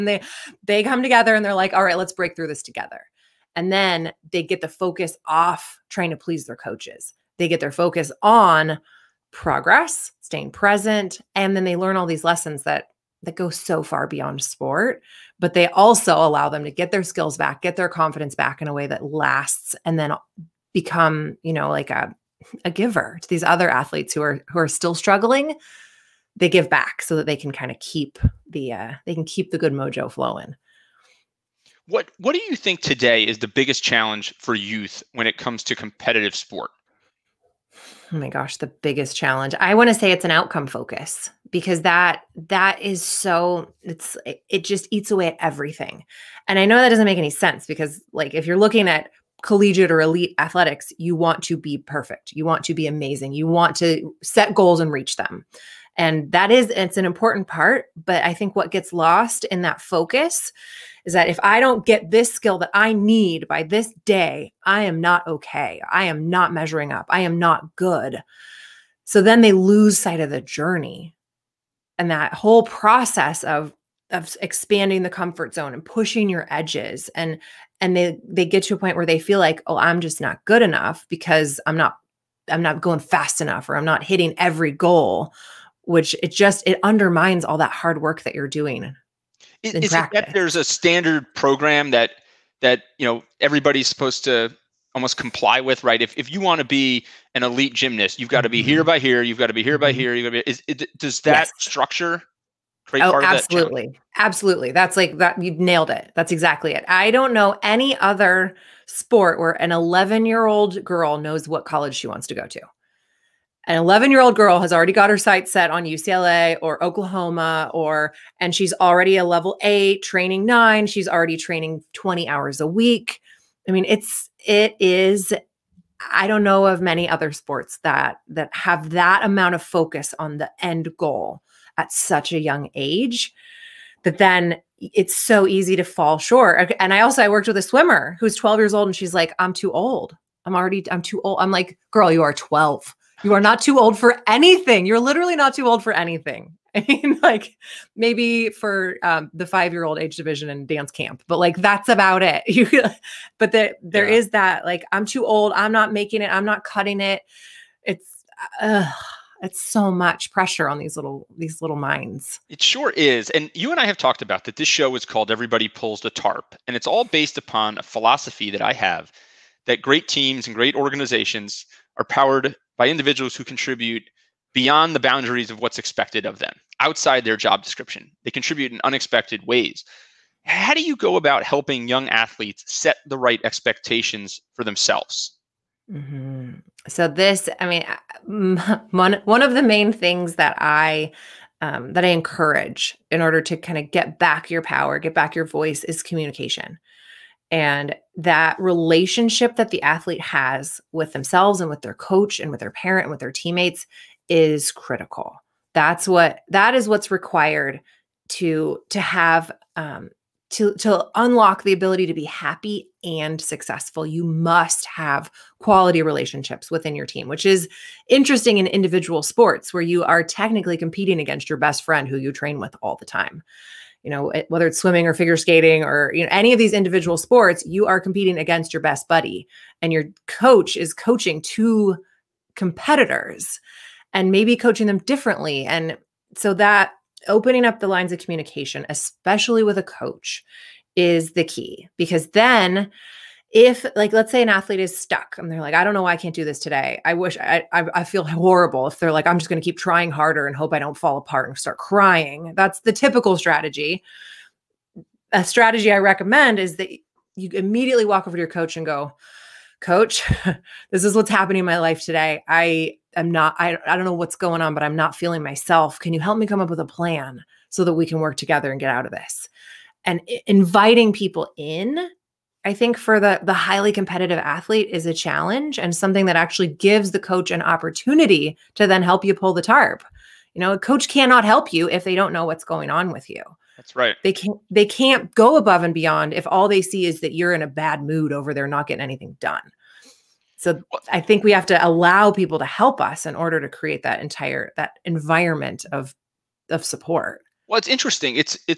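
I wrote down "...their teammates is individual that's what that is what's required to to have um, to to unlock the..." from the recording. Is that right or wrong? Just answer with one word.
wrong.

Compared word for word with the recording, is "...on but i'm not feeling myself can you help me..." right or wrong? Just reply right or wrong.
right.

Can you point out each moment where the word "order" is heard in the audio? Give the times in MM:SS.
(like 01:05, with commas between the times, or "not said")
03:13, 04:53.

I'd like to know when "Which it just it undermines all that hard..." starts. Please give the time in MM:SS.
01:25.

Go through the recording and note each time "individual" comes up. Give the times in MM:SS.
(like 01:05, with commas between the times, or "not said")
02:52, 03:38, 03:46.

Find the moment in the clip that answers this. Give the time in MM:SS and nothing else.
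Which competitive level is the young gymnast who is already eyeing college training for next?
02:00.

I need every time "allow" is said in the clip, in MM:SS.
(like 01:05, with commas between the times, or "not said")
00:16, 04:51.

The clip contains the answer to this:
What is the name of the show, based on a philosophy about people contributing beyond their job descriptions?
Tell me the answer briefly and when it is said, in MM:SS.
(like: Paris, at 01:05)
Everybody Pulls the Tarp, at 02:45.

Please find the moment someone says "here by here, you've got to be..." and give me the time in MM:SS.
01:38.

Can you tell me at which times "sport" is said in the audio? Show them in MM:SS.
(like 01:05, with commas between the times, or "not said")
00:14, 00:36, 01:48, 02:07, 03:39, 03:47.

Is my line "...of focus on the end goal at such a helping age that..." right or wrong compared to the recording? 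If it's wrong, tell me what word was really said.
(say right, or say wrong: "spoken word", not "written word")
wrong: "young", not "helping".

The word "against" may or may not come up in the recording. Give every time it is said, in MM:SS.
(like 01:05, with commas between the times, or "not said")
03:41, 03:48.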